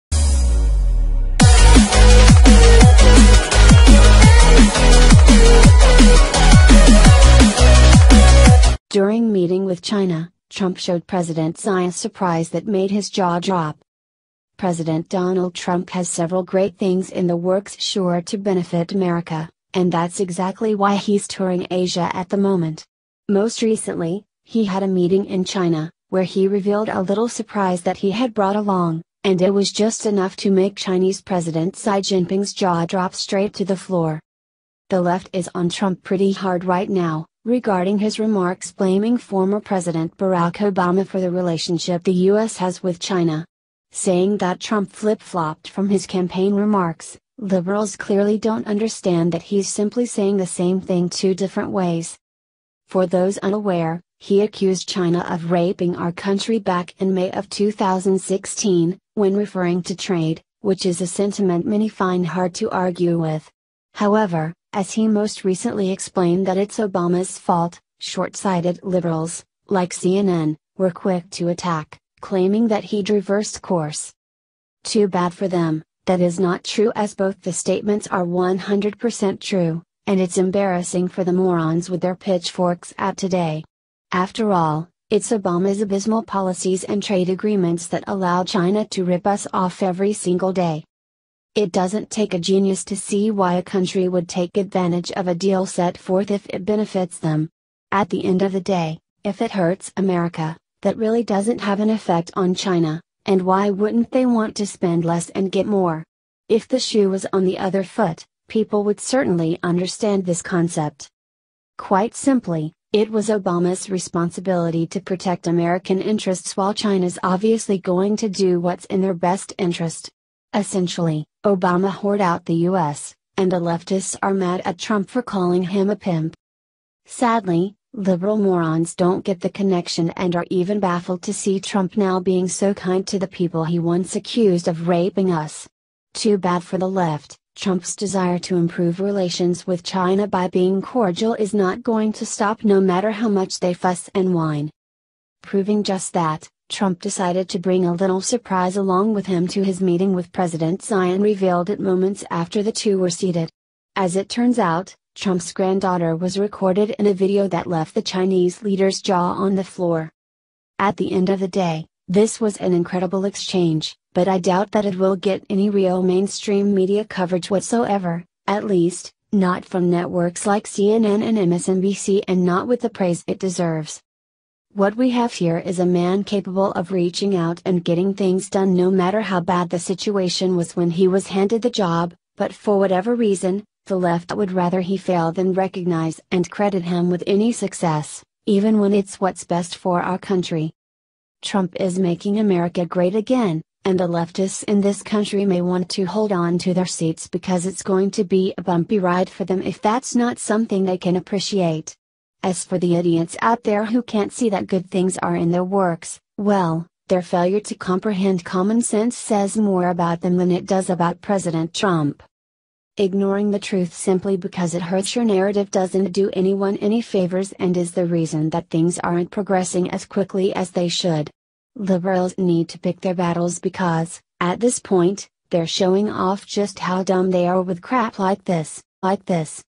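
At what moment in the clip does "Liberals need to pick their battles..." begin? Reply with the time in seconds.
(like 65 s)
221 s.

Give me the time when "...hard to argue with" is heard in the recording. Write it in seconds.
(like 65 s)
62 s.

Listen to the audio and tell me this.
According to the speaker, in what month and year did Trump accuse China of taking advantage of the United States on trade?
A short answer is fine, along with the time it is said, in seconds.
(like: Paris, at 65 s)
May 2016, at 57 s.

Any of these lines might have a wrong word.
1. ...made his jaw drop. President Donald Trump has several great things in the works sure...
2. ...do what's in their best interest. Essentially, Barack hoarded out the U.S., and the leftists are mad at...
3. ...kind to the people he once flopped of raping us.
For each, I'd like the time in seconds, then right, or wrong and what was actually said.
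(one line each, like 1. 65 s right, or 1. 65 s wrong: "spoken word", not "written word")
1. 12 s right
2. 118 s wrong: "Obama", not "Barack"
3. 132 s wrong: "accused", not "flopped".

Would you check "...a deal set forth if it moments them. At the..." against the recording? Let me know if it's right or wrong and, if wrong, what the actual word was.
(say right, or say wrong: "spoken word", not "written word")
wrong: "benefits", not "moments".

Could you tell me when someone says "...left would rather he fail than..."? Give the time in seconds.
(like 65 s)
183 s.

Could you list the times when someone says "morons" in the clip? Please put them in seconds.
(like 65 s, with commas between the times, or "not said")
81 s, 128 s.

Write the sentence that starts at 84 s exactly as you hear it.
After all, it's Obama's abysmal policies and trade agreements that allow China to rip us off every single day.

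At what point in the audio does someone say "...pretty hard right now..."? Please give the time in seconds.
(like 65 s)
36 s.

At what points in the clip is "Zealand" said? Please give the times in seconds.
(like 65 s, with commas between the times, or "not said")
not said.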